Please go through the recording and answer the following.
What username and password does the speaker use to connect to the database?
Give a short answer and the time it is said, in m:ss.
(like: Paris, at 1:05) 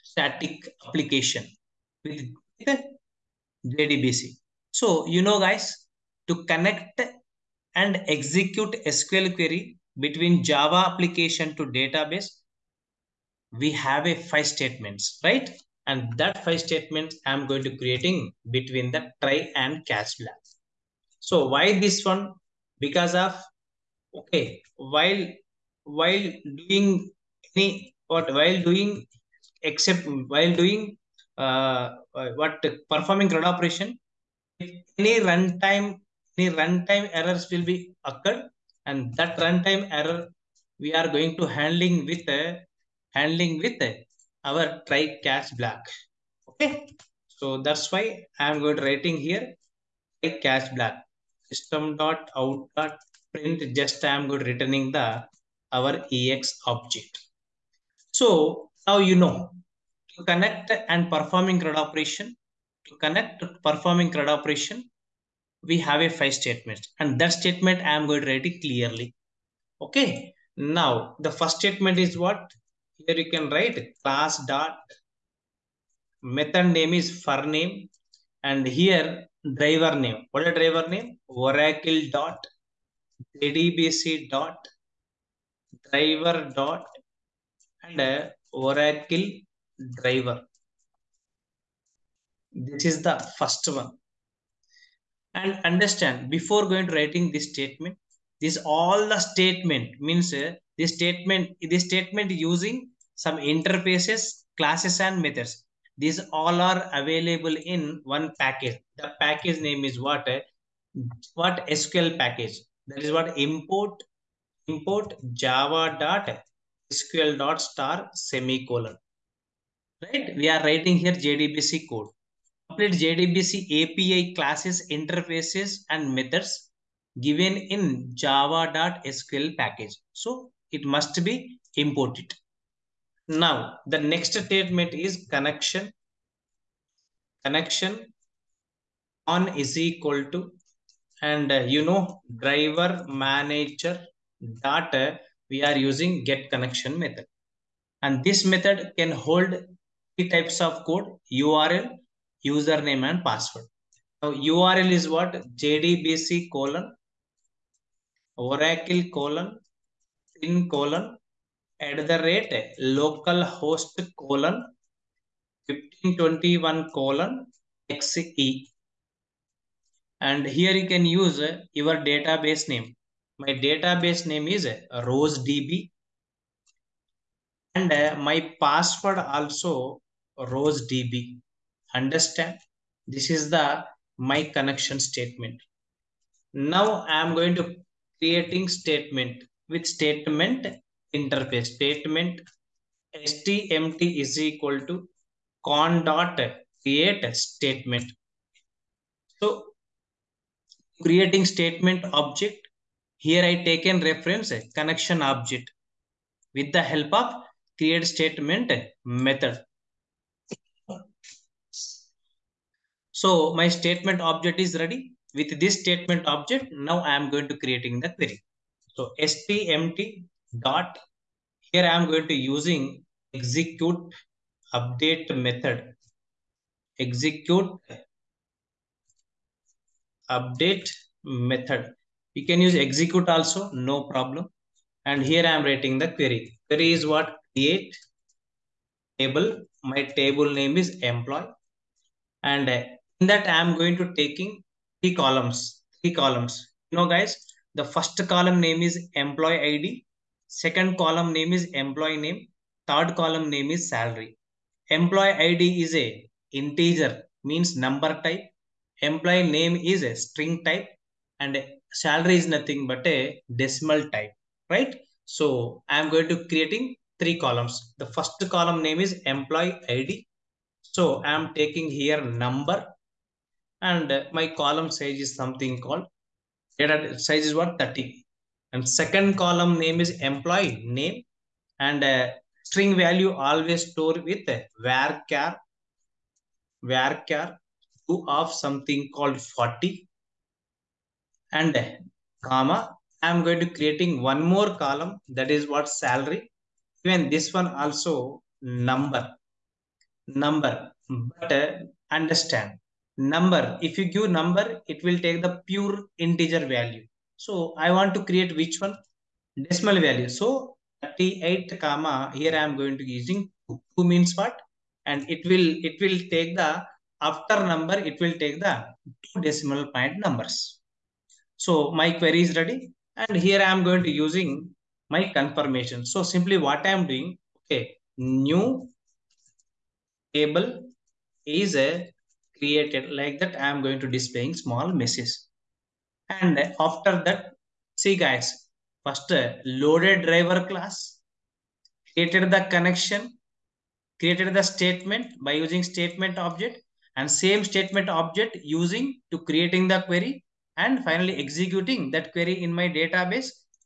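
rose db, at 2:55.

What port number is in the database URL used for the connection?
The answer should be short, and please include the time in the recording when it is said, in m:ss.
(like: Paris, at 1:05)
1521, at 2:45.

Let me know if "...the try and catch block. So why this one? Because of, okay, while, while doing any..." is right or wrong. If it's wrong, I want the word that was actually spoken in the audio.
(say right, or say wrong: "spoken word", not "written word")
right.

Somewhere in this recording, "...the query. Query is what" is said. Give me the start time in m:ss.
3:55.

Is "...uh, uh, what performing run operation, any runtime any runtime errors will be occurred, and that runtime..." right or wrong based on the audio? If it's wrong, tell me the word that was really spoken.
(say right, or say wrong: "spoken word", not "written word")
right.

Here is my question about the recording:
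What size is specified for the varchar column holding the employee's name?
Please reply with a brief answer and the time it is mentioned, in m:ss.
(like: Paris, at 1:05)
40, at 4:49.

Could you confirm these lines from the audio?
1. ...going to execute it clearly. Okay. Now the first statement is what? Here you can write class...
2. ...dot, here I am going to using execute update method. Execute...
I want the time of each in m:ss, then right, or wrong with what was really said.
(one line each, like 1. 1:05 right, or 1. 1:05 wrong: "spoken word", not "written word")
1. 1:08 wrong: "write", not "execute"
2. 3:40 right.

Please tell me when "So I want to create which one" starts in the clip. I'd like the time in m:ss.
5:07.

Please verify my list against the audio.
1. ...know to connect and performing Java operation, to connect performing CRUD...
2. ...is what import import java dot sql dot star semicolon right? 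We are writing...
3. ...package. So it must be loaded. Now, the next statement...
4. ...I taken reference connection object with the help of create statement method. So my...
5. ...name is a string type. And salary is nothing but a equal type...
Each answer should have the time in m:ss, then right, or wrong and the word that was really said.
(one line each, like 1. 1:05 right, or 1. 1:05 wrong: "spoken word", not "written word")
1. 0:59 wrong: "CRUD", not "Java"
2. 1:53 right
3. 2:09 wrong: "imported", not "loaded"
4. 3:23 right
5. 4:19 wrong: "decimal", not "equal".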